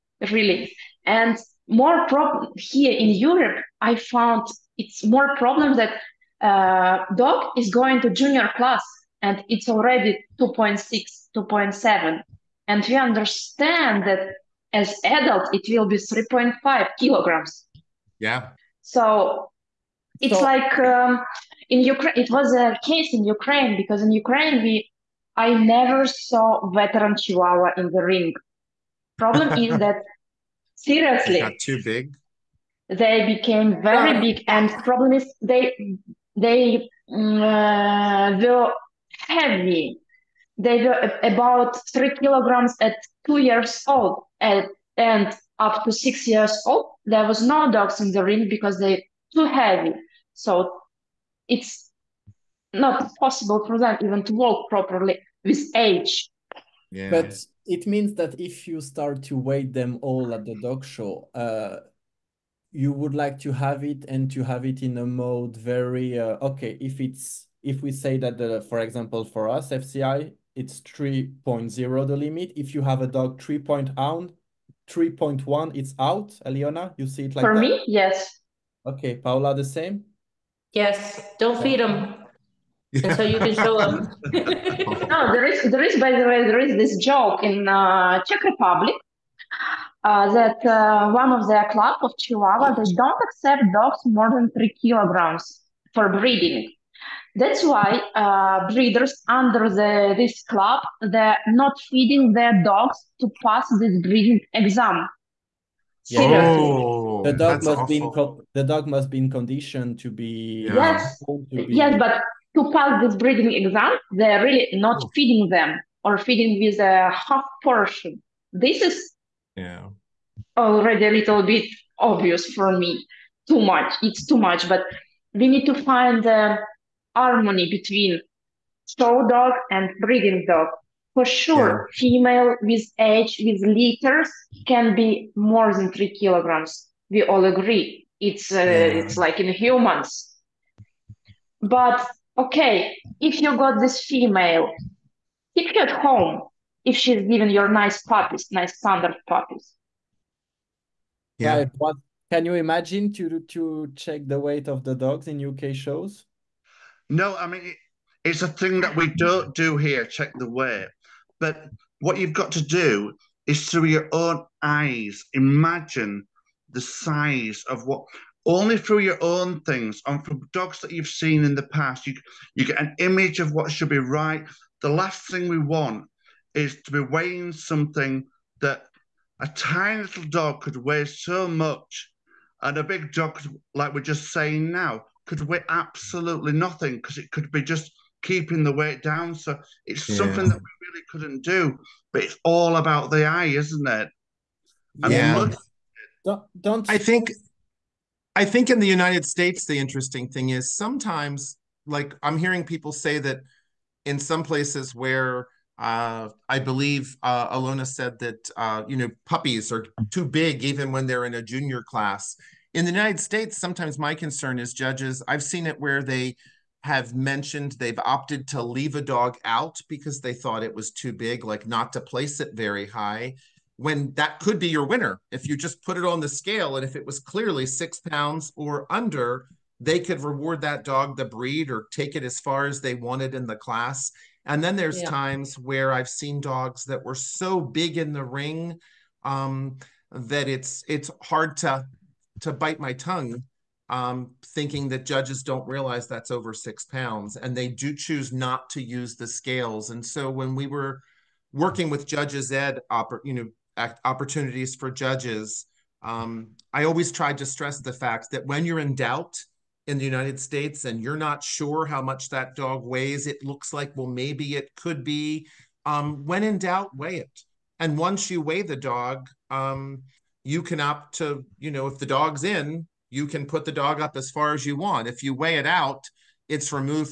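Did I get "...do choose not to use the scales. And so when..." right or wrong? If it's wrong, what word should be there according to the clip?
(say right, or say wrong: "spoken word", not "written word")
right.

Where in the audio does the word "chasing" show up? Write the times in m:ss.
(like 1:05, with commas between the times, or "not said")
not said.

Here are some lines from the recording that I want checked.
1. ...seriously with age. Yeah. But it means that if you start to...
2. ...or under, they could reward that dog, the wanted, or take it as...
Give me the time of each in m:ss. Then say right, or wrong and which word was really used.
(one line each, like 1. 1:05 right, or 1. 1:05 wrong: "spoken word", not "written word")
1. 0:54 wrong: "properly", not "seriously"
2. 3:48 wrong: "breed", not "wanted".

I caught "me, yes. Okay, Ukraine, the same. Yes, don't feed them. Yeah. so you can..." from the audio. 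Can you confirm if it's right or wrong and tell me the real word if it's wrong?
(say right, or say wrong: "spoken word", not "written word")
wrong: "Paula", not "Ukraine".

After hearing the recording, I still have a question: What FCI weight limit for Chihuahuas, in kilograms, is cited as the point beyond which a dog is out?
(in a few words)
3.0.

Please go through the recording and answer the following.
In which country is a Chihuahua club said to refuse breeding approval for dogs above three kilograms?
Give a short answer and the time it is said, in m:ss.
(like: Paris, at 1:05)
Czech Republic, at 1:28.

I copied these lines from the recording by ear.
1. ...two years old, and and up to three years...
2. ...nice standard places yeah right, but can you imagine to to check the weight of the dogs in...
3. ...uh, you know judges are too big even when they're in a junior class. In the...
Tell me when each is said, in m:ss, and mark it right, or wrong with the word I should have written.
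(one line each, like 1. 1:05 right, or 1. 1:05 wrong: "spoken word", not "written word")
1. 0:43 wrong: "six", not "three"
2. 2:28 wrong: "puppies", not "places"
3. 3:28 wrong: "puppies", not "judges".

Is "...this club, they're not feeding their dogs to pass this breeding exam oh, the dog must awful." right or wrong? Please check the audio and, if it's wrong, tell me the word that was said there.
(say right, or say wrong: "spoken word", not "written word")
right.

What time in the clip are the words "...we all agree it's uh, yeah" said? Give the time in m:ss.
2:17.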